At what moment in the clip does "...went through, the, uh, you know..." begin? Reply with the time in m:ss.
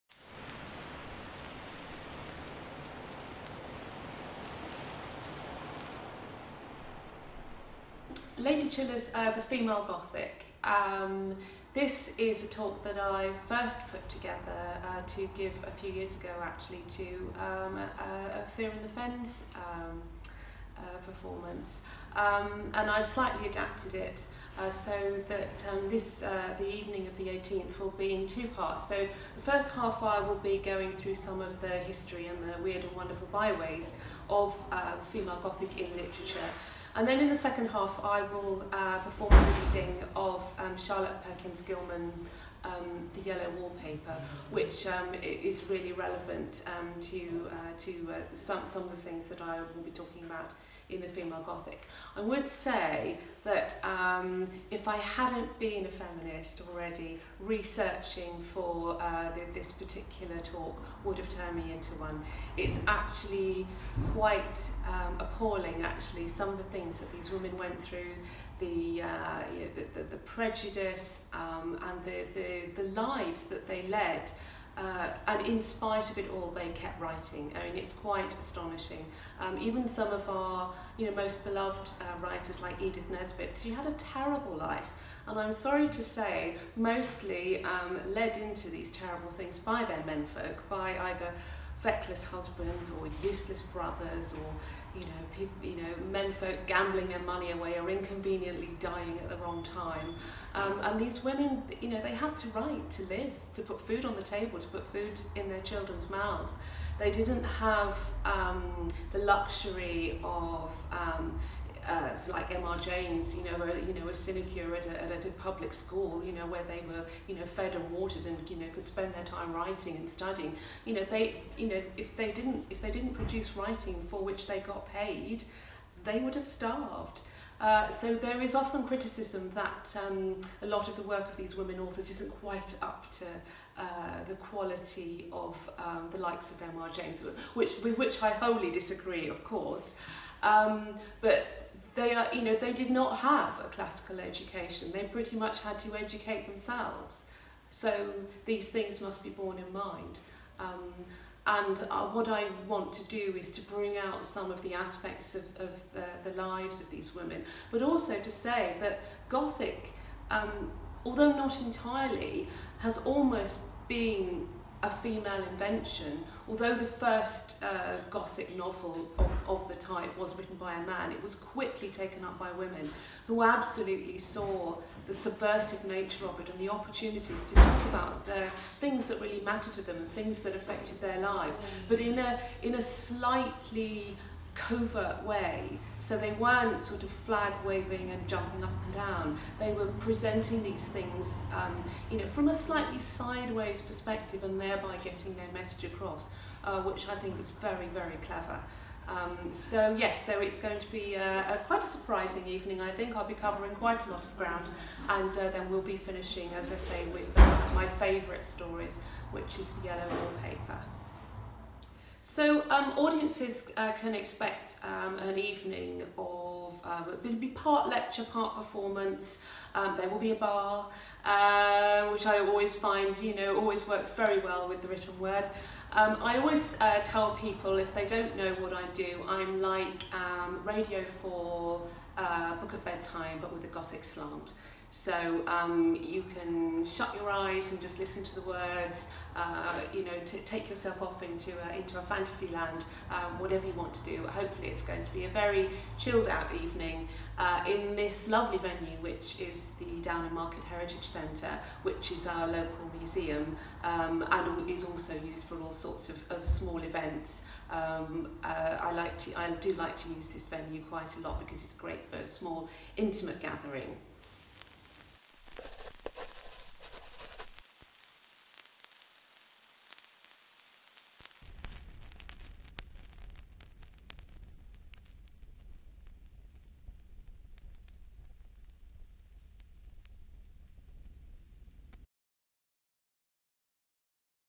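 1:07.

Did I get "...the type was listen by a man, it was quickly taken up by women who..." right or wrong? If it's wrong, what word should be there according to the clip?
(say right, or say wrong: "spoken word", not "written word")
wrong: "written", not "listen".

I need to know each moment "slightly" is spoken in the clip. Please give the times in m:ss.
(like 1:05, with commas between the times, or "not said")
0:23, 3:02, 3:12.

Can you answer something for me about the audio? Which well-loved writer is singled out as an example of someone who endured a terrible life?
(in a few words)
Edith Nesbit.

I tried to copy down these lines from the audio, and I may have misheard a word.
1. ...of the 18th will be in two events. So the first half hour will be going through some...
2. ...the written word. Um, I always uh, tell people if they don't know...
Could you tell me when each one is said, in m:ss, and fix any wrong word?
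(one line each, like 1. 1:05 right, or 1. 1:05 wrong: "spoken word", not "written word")
1. 0:27 wrong: "parts", not "events"
2. 3:44 right.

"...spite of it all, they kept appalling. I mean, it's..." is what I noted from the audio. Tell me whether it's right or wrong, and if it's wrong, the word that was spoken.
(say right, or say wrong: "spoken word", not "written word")
wrong: "writing", not "appalling".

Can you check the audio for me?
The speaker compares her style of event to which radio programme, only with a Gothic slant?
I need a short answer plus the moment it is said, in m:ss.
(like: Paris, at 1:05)
Book of Bedtime, at 3:52.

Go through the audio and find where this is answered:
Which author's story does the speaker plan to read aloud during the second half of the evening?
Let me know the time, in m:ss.
0:40.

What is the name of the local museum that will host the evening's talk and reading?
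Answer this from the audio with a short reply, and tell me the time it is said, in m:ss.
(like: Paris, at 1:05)
Downham Market Heritage Centre, at 4:10.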